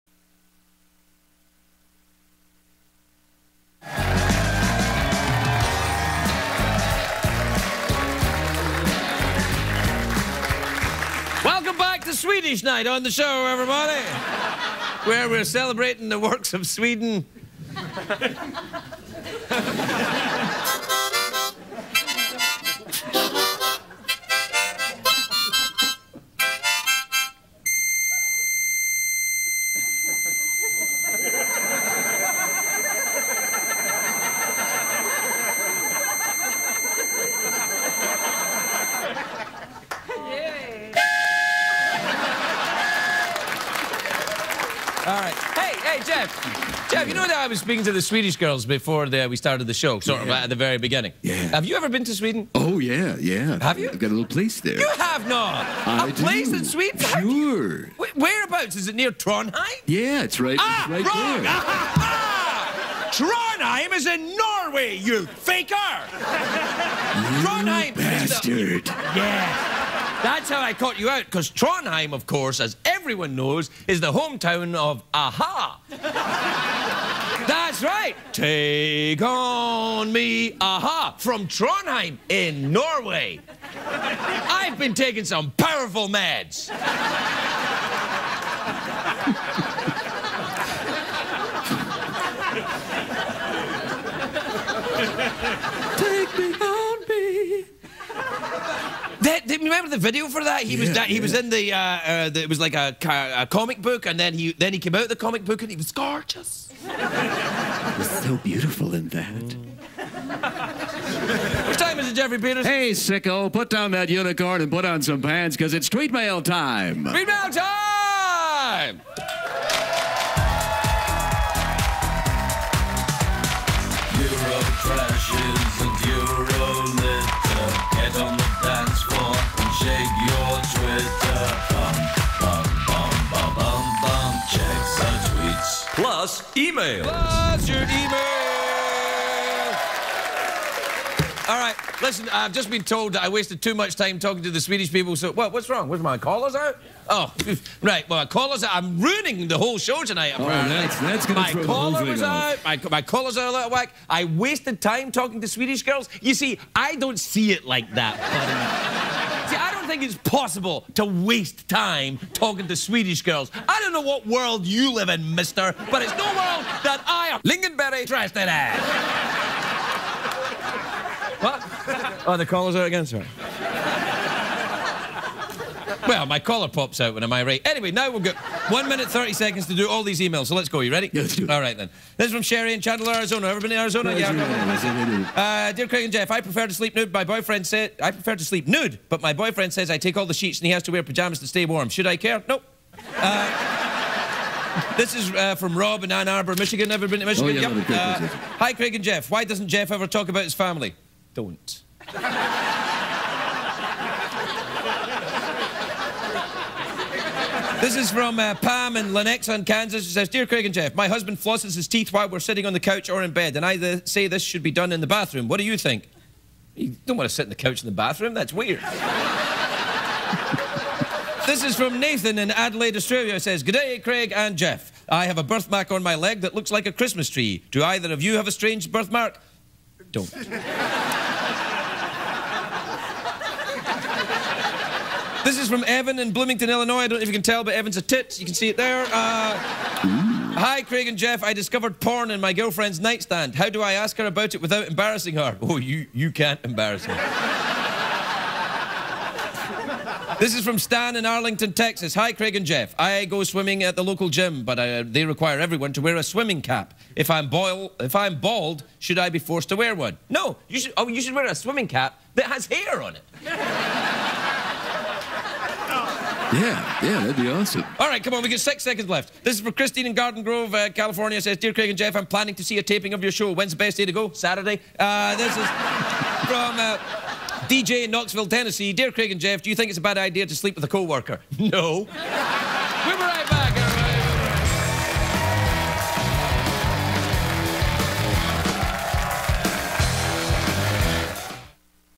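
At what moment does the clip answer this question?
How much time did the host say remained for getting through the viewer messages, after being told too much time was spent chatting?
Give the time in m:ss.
2:58.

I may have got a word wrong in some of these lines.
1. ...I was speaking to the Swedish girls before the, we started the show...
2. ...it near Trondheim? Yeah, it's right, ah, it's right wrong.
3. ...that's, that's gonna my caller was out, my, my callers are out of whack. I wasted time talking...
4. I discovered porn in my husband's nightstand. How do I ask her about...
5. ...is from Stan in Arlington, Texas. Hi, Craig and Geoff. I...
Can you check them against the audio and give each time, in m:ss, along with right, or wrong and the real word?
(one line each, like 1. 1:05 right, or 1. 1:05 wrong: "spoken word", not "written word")
1. 0:47 right
2. 0:58 right
3. 2:30 right
4. 4:01 wrong: "girlfriend", not "husband"
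5. 4:10 right.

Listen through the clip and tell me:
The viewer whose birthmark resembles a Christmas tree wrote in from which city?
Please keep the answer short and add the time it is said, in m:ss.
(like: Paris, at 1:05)
Adelaide, at 3:42.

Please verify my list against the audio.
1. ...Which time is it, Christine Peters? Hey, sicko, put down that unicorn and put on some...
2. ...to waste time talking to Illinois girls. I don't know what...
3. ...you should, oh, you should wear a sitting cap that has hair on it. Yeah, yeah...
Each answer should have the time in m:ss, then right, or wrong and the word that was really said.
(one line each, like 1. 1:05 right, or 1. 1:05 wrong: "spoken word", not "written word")
1. 1:51 wrong: "Geoffrey", not "Christine"
2. 2:40 wrong: "Swedish", not "Illinois"
3. 4:20 wrong: "swimming", not "sitting".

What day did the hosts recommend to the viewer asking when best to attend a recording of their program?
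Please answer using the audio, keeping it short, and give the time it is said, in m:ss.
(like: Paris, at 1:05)
Saturday, at 4:34.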